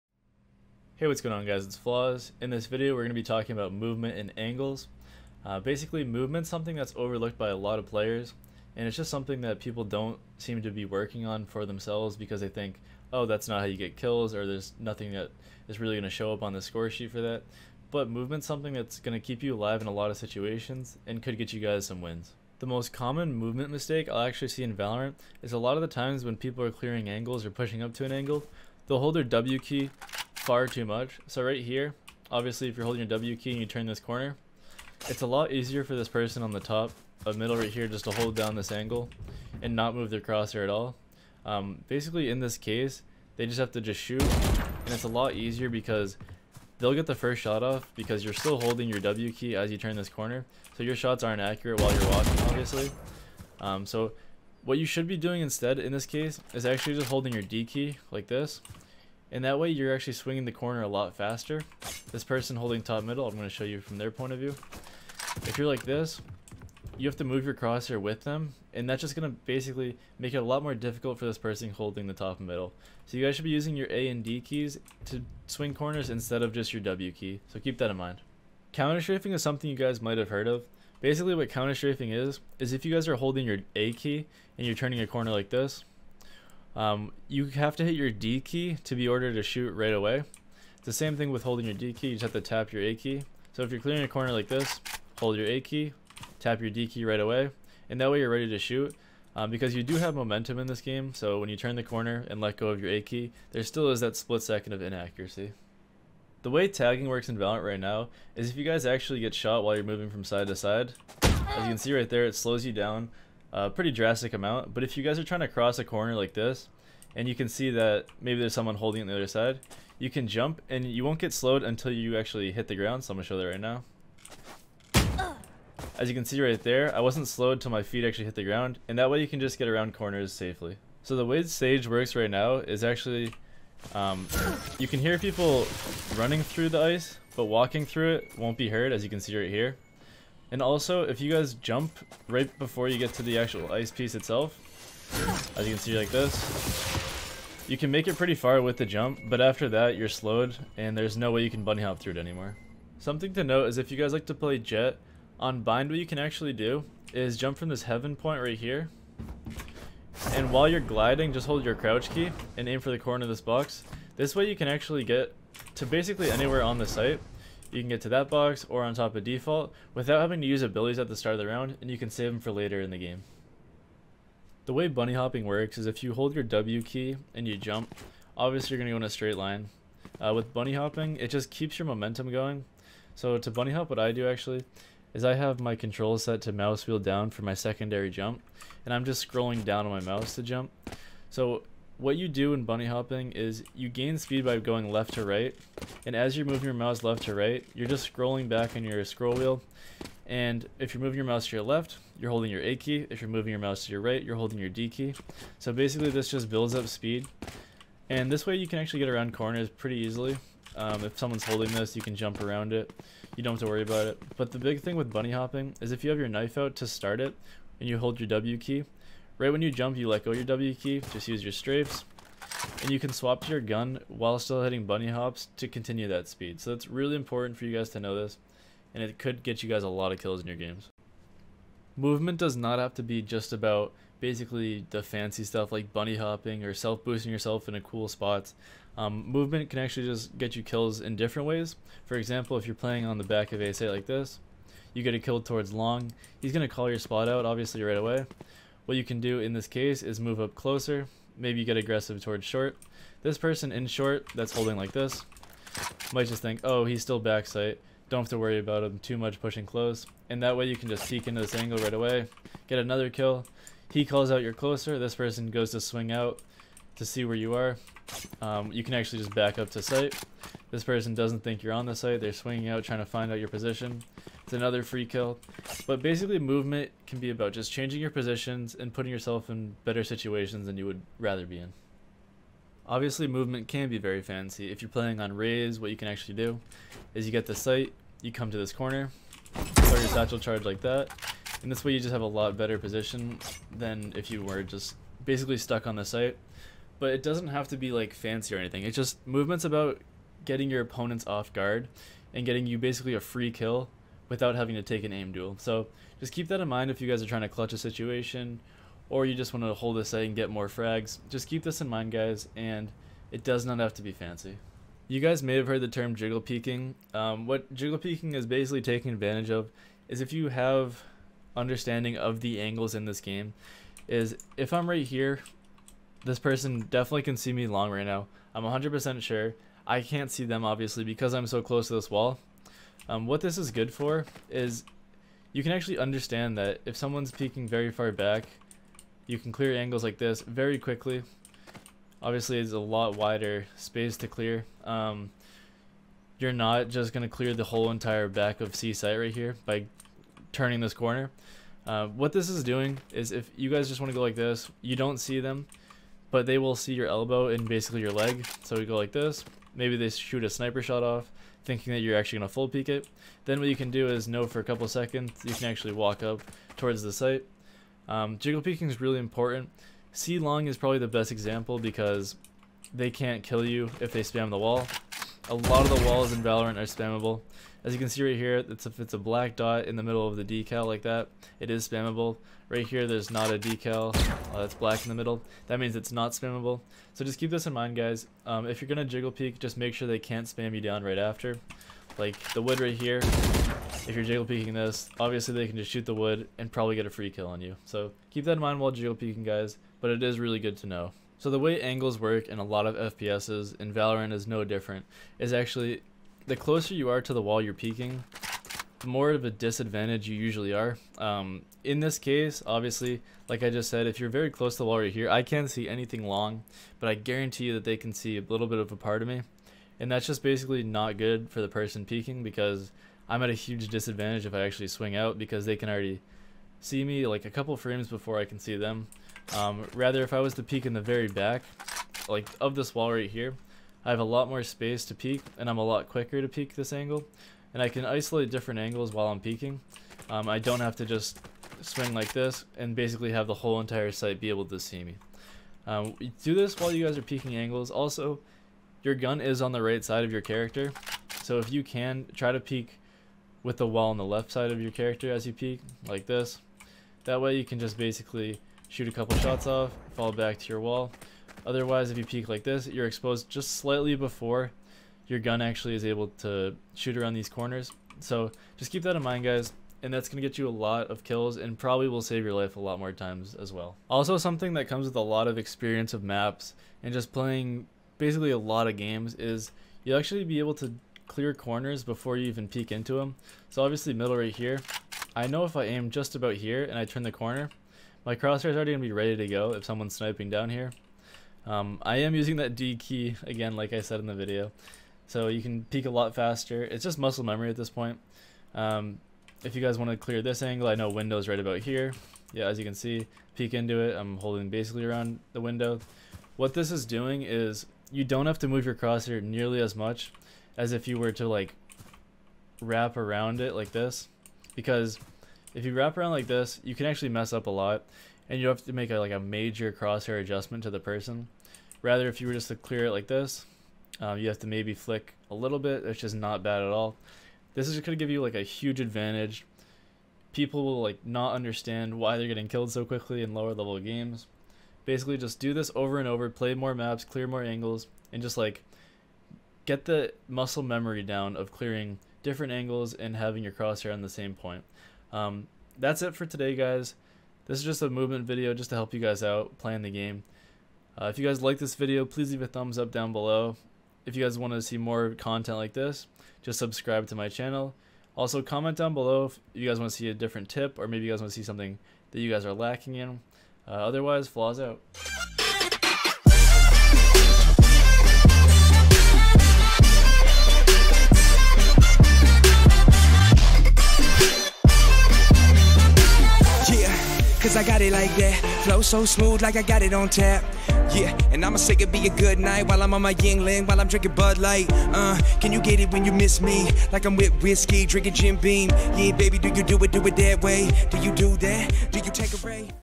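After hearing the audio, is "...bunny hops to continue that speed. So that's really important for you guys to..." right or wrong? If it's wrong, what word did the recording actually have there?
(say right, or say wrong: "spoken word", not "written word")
right.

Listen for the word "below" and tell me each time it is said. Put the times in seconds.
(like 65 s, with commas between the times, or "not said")
553 s, 559 s.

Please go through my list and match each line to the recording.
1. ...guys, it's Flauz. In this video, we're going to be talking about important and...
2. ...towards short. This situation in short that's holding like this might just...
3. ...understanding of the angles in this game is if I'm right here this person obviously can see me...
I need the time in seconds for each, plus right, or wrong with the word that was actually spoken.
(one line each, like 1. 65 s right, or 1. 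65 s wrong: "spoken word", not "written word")
1. 1 s wrong: "movement", not "important"
2. 252 s wrong: "person", not "situation"
3. 321 s wrong: "definitely", not "obviously".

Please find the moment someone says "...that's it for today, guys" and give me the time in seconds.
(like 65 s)
545 s.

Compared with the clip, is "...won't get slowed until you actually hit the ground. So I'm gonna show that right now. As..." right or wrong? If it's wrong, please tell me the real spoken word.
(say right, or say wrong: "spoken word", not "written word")
right.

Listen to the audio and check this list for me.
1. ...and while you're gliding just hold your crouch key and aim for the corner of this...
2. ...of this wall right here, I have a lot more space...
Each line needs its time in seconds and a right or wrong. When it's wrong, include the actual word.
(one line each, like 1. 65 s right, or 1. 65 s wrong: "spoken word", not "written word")
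1. 160 s right
2. 432 s right.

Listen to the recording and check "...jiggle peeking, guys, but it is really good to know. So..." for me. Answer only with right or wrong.
right.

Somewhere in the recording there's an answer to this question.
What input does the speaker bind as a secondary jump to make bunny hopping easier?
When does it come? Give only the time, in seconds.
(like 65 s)
186 s.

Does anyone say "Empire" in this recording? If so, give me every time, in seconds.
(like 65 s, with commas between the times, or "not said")
not said.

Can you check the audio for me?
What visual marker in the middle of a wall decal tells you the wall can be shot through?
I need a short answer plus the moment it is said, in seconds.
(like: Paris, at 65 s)
Black dot, at 379 s.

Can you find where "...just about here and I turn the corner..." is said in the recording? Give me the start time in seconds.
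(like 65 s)
486 s.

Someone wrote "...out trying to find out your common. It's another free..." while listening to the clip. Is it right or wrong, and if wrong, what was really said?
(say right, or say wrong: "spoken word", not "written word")
wrong: "position", not "common".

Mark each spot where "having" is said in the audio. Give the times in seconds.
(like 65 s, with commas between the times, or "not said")
170 s, 304 s, 543 s.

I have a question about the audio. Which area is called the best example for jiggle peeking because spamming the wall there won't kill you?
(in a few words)
C Long.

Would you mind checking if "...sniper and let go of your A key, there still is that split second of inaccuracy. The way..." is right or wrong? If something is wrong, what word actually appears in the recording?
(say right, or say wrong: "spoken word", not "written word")
wrong: "corner", not "sniper".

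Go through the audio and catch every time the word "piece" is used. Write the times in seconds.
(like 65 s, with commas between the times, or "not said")
143 s.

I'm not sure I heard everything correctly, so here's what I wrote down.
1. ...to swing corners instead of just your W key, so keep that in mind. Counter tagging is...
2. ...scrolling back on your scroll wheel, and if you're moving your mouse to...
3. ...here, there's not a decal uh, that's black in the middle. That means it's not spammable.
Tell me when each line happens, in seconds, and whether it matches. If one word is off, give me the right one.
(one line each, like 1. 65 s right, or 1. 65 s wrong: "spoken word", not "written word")
1. 75 s wrong: "strafing", not "tagging"
2. 198 s right
3. 382 s right.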